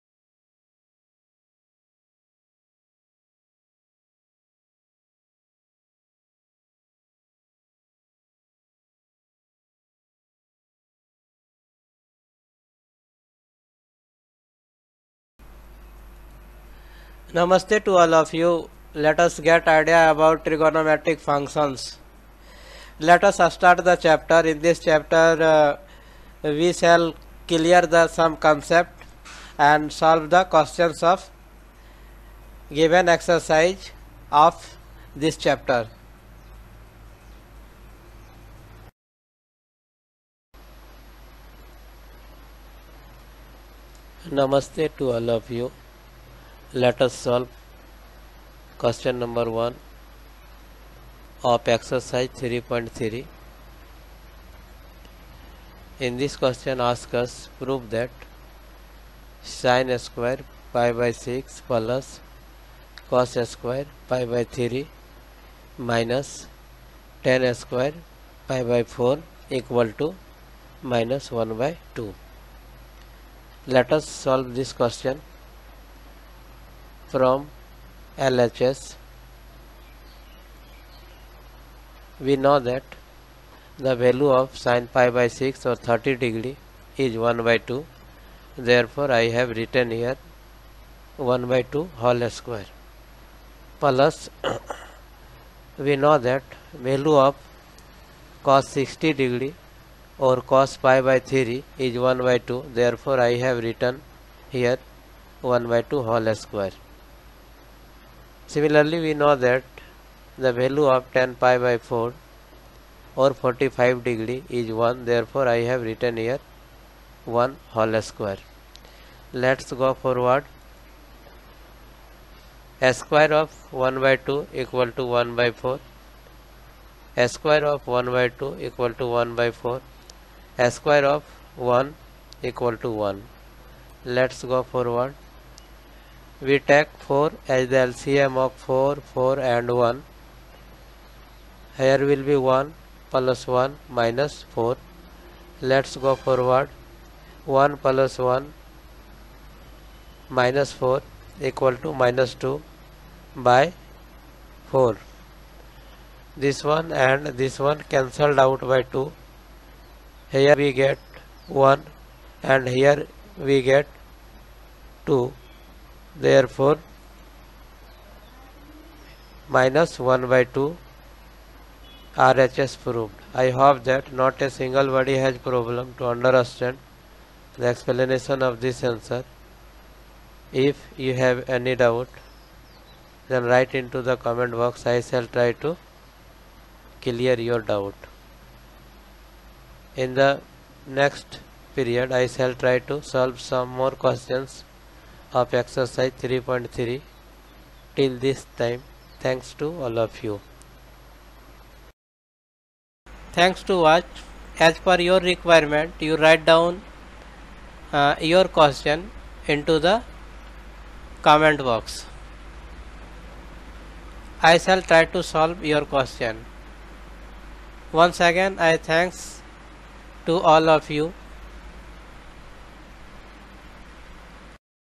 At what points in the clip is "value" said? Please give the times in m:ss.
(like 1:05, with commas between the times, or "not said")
1:24, 1:36, 1:50.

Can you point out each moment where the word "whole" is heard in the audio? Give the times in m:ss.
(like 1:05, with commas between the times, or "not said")
1:32, 1:46, 1:57.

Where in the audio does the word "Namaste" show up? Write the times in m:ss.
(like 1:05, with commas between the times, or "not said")
0:17, 0:44.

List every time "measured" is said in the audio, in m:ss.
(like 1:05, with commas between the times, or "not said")
not said.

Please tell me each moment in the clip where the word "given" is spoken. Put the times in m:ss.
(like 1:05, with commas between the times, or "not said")
0:32.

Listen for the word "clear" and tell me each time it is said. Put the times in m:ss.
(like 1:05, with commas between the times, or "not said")
0:27, 3:07.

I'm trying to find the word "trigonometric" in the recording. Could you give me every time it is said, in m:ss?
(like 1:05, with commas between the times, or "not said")
0:20.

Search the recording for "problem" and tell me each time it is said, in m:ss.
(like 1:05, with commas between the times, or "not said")
2:55.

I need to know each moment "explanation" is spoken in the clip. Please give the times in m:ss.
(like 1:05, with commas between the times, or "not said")
2:57.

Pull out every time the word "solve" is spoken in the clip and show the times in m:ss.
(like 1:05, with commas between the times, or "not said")
0:29, 0:47, 1:14, 3:13, 3:35.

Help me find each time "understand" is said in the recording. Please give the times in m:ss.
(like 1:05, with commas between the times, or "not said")
2:56.